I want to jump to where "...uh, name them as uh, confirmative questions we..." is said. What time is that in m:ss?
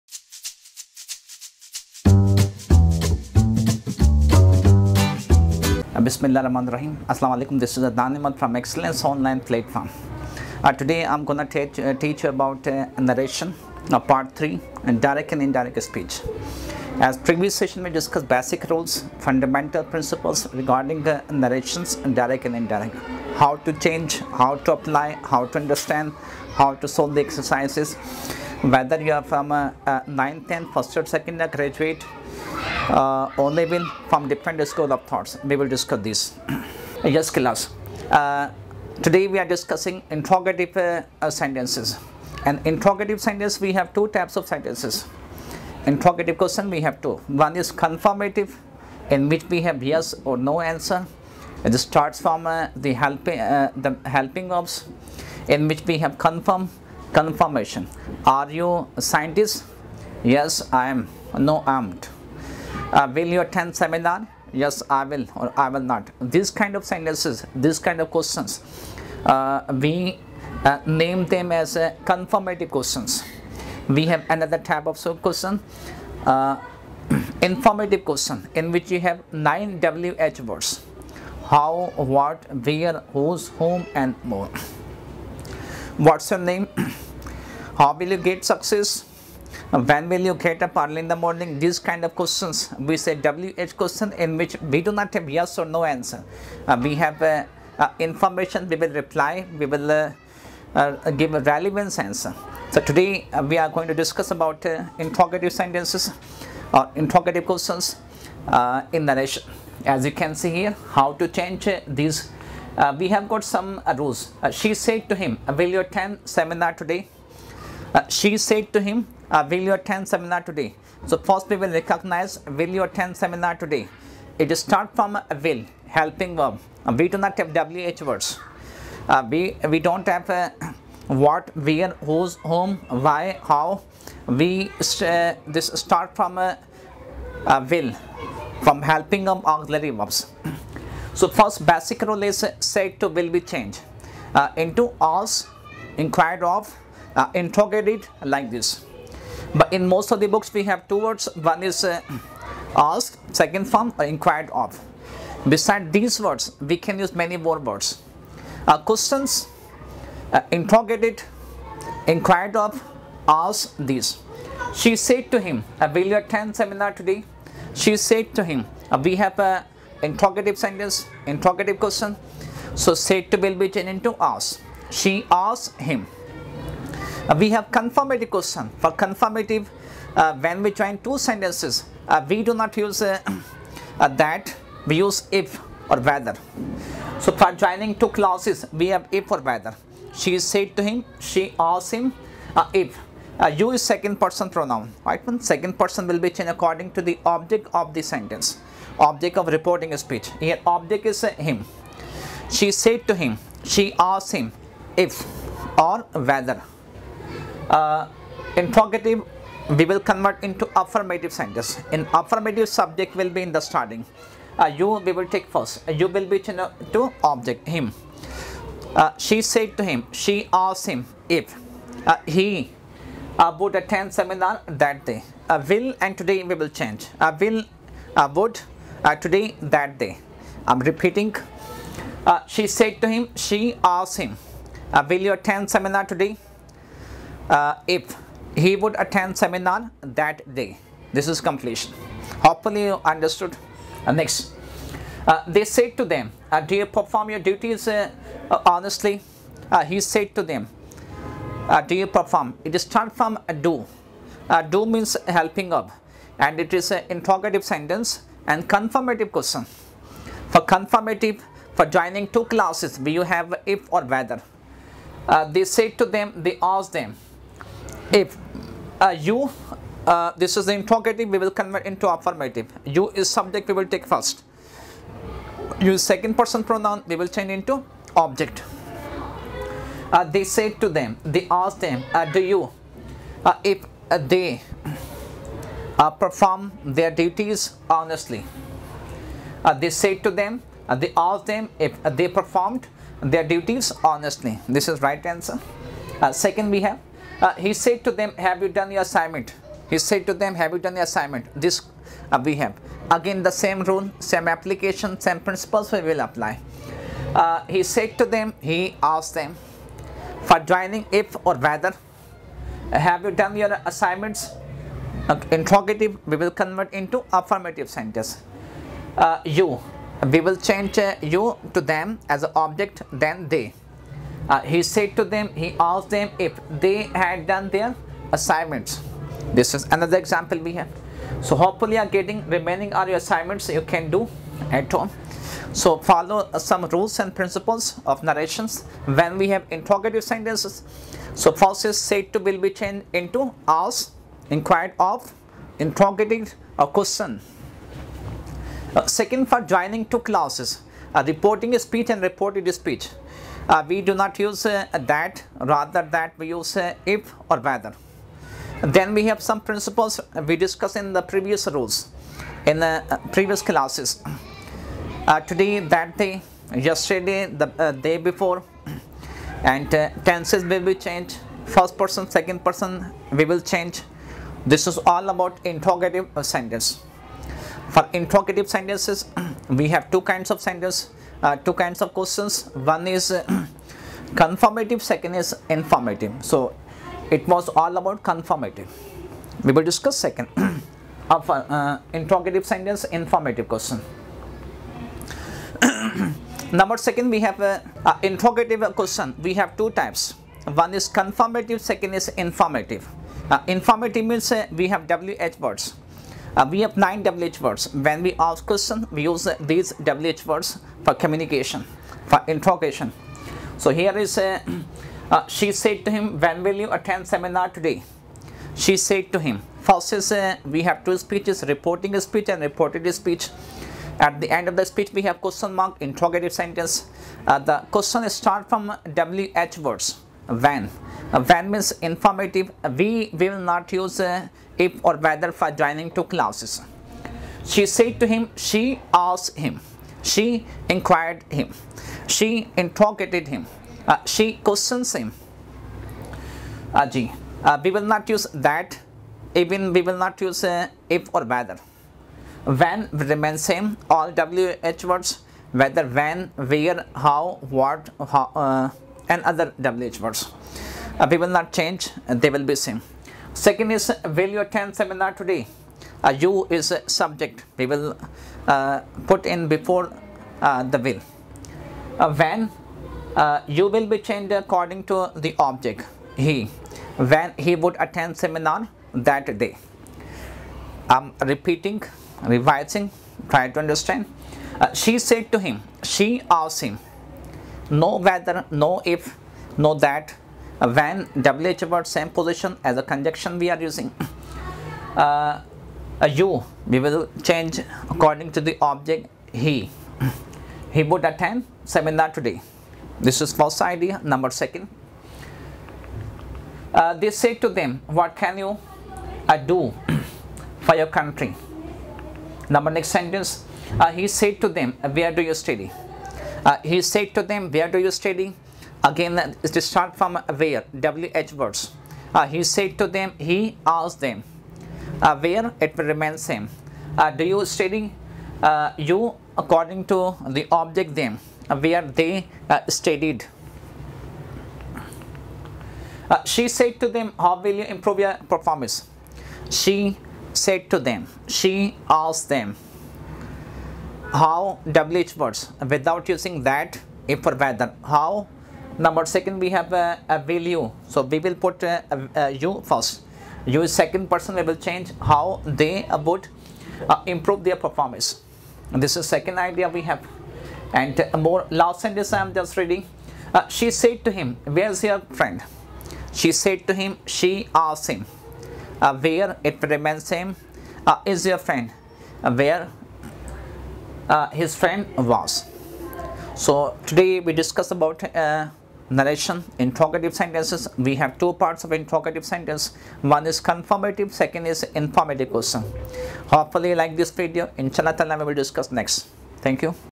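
1:10.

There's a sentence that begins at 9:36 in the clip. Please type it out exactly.
So today we discuss about uh, narration interrogative sentences.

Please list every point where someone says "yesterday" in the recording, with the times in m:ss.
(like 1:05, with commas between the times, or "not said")
6:06.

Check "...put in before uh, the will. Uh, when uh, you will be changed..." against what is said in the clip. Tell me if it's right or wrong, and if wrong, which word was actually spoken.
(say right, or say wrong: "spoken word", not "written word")
right.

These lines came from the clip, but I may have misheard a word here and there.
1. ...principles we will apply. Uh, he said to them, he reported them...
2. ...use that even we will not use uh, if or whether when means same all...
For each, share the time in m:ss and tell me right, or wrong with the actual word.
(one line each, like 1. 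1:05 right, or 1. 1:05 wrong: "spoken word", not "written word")
1. 5:05 wrong: "asked", not "reported"
2. 7:28 wrong: "remains", not "means".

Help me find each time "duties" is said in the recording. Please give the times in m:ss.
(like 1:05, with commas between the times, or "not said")
4:07, 4:47, 4:53.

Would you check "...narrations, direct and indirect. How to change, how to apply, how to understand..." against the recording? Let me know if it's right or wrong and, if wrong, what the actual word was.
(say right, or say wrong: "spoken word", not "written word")
right.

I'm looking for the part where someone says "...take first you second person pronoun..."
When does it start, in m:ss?
4:33.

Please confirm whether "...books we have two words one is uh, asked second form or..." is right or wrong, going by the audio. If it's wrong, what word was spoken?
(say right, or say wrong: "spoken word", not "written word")
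right.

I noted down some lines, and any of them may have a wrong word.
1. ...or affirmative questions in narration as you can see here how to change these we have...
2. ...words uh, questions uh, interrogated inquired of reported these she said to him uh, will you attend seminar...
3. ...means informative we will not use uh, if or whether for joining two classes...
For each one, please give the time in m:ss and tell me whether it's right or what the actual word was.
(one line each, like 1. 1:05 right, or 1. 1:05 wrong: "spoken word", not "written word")
1. 1:46 wrong: "interrogative", not "affirmative"
2. 2:37 wrong: "asked", not "reported"
3. 7:11 right.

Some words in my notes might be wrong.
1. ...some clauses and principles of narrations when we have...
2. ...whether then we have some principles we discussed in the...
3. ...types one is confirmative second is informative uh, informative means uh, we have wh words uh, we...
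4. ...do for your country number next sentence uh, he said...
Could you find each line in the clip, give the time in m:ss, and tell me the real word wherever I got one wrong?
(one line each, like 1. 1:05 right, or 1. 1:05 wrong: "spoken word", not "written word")
1. 5:36 wrong: "rules", not "clauses"
2. 5:57 right
3. 6:39 right
4. 8:29 right.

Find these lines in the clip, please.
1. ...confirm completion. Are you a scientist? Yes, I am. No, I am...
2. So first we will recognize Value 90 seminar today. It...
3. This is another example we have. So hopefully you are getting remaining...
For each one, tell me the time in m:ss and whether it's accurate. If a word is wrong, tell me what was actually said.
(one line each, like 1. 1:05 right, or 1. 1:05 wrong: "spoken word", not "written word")
1. 0:56 wrong: "confirmation", not "completion"
2. 2:01 wrong: "10", not "90"
3. 5:29 right.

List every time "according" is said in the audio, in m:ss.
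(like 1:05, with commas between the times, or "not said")
3:16, 7:54, 8:18, 8:49.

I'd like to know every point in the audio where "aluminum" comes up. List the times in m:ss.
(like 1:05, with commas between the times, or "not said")
not said.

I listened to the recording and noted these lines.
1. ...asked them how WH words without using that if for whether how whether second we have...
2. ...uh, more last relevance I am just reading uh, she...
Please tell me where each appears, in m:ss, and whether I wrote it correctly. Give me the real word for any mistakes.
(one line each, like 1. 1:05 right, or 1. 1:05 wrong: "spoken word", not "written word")
1. 9:02 wrong: "number", not "whether"
2. 9:21 wrong: "sentence", not "relevance".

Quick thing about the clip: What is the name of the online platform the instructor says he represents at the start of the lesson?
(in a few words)
Excellence Online Platform.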